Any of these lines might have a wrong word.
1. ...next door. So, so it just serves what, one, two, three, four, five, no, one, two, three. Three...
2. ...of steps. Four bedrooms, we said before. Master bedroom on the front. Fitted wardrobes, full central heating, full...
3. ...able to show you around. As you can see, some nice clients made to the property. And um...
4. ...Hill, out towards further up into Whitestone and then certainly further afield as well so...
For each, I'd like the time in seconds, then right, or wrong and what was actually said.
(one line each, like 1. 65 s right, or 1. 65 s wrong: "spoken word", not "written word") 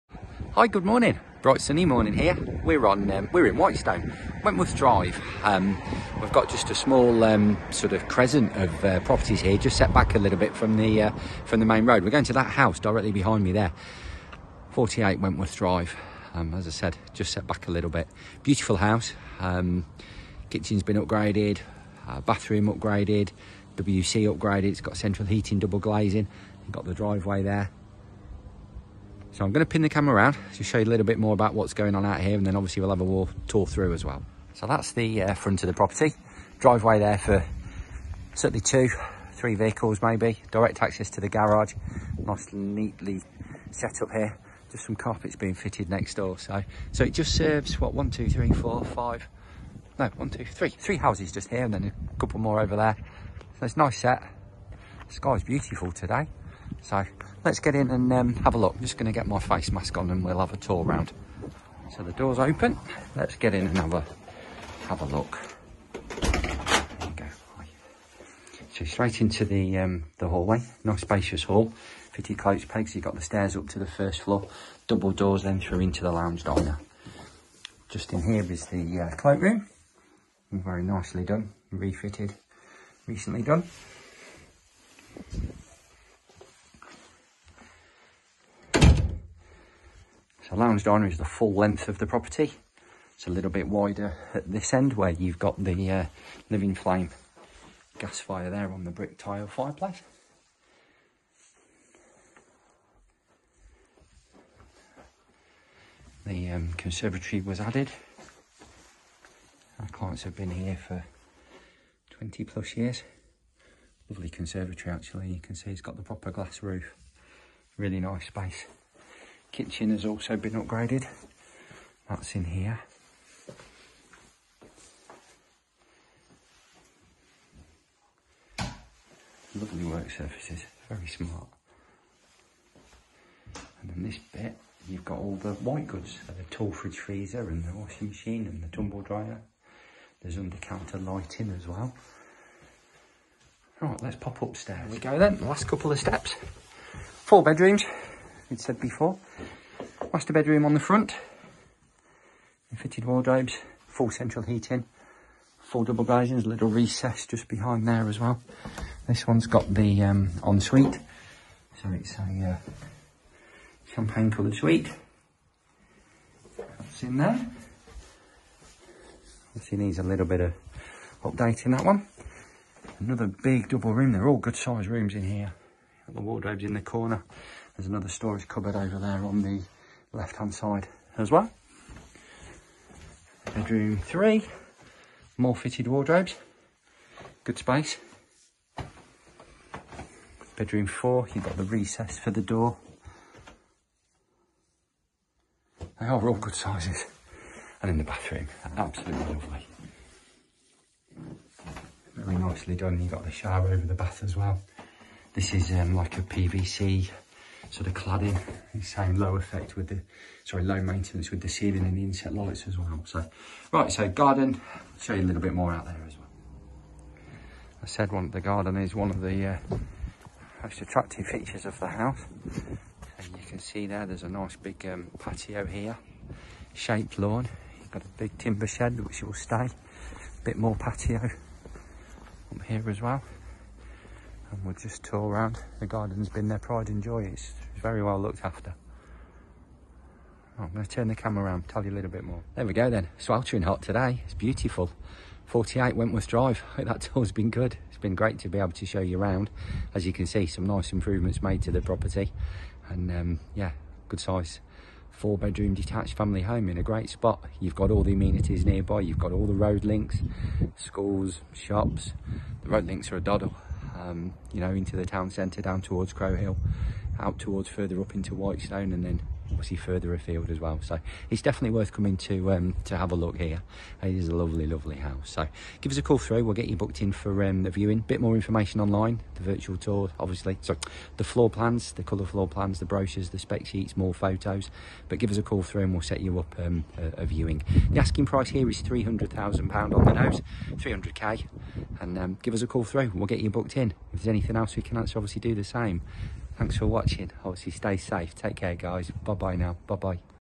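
1. 45 s right
2. 145 s right
3. 248 s wrong: "improvements", not "clients"
4. 266 s wrong: "obviously", not "certainly".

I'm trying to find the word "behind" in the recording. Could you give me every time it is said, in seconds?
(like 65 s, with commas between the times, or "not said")
13 s, 157 s.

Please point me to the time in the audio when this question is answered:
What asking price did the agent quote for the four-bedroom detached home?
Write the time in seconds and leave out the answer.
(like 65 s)
288 s.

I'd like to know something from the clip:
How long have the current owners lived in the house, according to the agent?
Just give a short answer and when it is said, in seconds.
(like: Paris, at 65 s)
20 plus years, at 112 s.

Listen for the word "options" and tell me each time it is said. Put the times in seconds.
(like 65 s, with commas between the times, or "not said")
not said.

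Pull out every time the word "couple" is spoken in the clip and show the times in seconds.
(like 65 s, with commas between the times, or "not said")
52 s, 145 s.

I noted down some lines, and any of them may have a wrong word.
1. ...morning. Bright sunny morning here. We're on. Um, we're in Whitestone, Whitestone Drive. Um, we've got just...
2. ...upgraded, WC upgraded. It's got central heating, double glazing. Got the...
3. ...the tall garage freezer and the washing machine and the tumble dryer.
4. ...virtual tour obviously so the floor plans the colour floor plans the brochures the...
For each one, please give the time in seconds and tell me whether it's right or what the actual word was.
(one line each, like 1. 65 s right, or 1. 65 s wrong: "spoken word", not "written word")
1. 0 s wrong: "Wentworth", not "Whitestone"
2. 22 s right
3. 136 s wrong: "fridge", not "garage"
4. 279 s right.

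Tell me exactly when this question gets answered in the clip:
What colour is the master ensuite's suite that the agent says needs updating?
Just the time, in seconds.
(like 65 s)
163 s.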